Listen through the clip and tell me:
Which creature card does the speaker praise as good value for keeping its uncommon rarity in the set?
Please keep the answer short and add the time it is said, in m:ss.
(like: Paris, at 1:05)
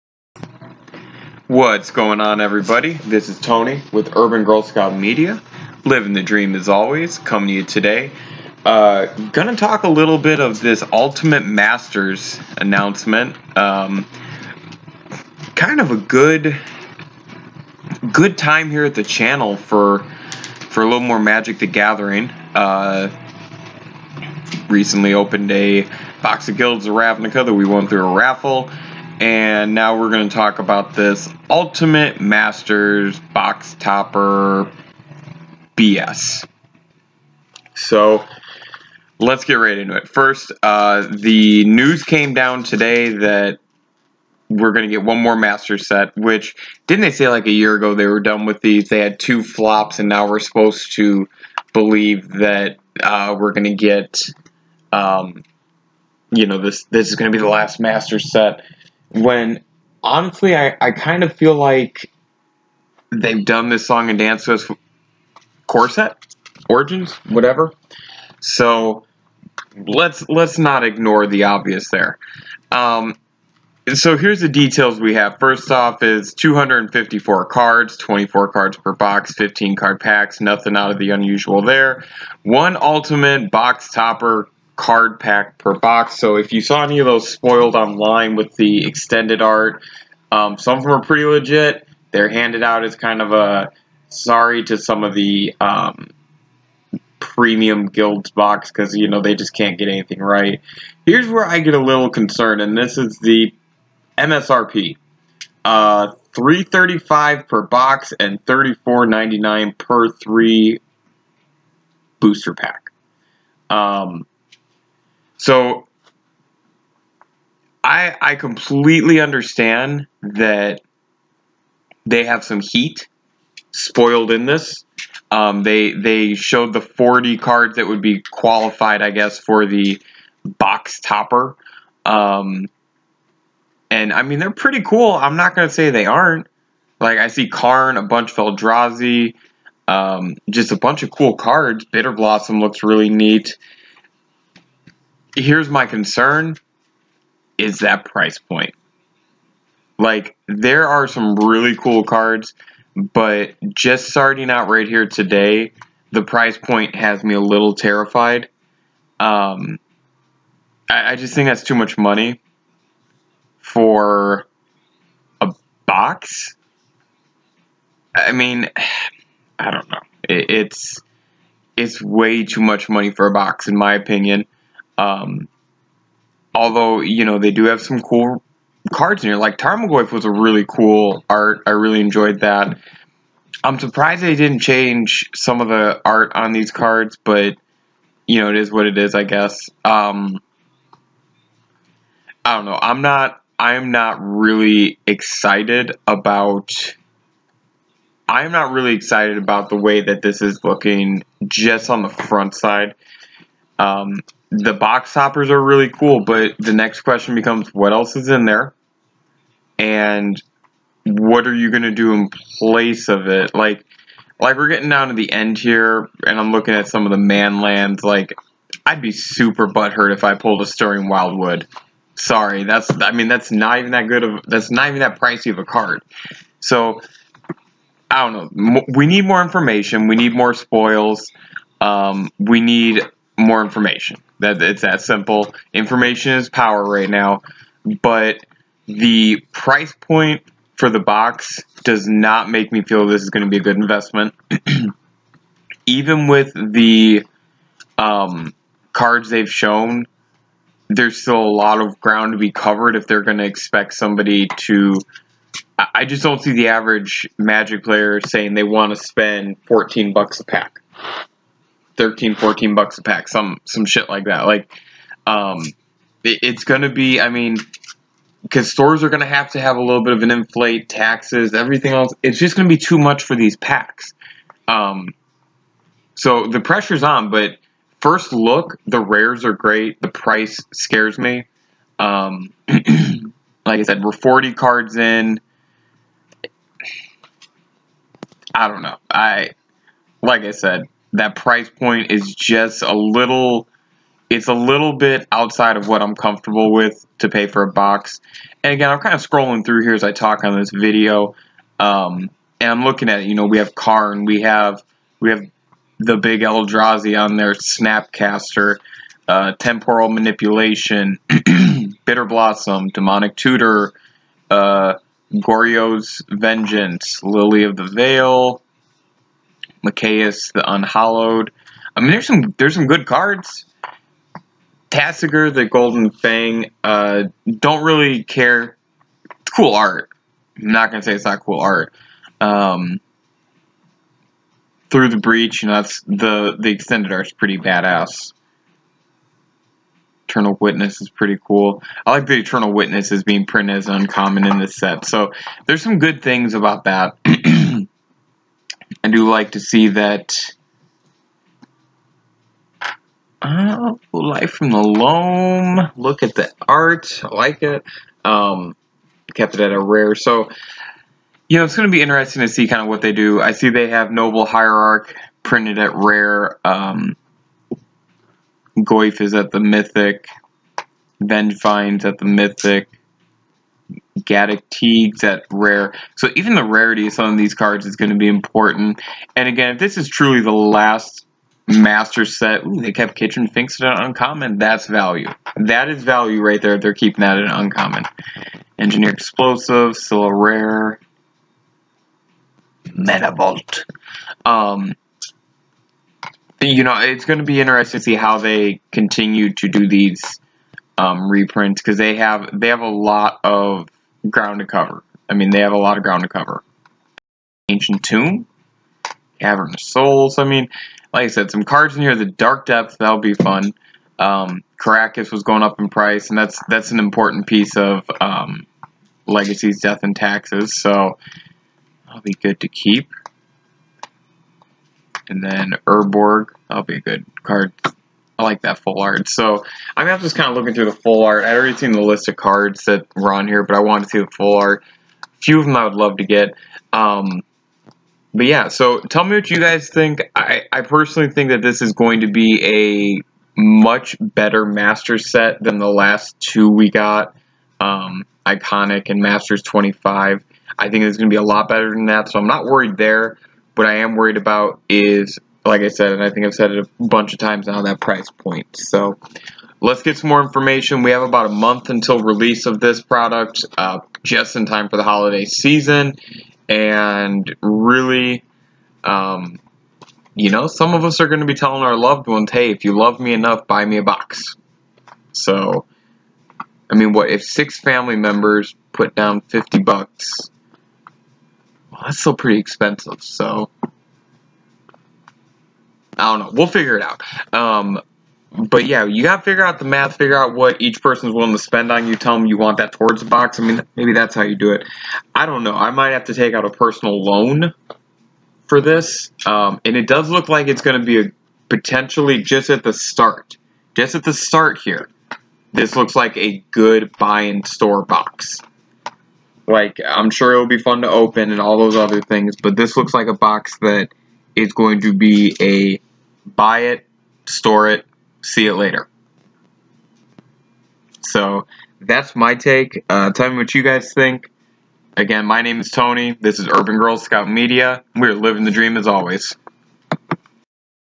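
Kitchen Finks, at 6:23.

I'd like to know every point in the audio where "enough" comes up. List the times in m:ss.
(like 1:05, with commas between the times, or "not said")
7:53.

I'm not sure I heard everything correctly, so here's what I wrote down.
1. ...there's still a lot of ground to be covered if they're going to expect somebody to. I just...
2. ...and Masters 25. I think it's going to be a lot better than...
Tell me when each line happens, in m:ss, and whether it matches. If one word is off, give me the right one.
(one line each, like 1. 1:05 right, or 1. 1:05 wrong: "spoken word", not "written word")
1. 4:10 right
2. 7:29 right.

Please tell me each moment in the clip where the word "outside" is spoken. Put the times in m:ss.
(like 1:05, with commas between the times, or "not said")
4:55.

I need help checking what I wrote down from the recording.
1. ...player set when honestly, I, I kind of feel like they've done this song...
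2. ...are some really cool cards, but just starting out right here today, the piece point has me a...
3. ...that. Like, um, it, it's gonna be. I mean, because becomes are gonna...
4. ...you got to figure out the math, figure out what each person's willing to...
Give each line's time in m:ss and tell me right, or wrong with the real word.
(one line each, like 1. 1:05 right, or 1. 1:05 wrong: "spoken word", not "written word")
1. 0:57 wrong: "master", not "player"
2. 2:30 wrong: "price", not "piece"
3. 4:24 wrong: "stores", not "becomes"
4. 8:09 right.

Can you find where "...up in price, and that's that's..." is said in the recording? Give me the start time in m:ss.
6:55.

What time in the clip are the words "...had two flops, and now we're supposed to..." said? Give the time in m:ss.
0:48.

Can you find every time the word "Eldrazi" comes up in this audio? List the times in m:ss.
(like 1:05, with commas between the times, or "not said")
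2:18, 5:06.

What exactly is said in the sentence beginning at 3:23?
Um, the box toppers are really cool, but the next question becomes what else is in there?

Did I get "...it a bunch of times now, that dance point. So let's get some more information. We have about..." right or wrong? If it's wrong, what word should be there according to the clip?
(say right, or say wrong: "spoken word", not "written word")
wrong: "price", not "dance".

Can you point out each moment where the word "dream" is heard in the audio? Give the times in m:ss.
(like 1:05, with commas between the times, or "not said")
0:06, 8:48.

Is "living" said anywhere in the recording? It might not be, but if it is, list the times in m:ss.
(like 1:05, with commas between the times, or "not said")
0:05, 8:48.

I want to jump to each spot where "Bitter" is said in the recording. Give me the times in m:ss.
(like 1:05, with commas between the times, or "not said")
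2:21, 5:12.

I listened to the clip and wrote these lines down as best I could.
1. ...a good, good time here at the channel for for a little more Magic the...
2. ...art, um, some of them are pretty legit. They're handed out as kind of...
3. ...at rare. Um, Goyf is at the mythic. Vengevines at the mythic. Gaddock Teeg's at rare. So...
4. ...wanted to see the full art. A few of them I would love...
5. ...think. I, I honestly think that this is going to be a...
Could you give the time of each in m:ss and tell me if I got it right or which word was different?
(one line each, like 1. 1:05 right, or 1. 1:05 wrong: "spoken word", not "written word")
1. 0:15 right
2. 1:29 right
3. 6:05 right
4. 7:13 right
5. 7:19 wrong: "personally", not "honestly".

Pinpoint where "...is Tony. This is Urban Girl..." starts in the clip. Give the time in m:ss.
8:45.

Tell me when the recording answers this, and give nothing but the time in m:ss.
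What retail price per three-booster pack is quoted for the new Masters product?
1:48.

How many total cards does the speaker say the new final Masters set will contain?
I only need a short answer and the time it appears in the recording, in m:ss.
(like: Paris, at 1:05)
254, at 1:16.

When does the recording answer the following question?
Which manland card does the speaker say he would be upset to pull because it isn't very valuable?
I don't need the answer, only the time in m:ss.
3:40.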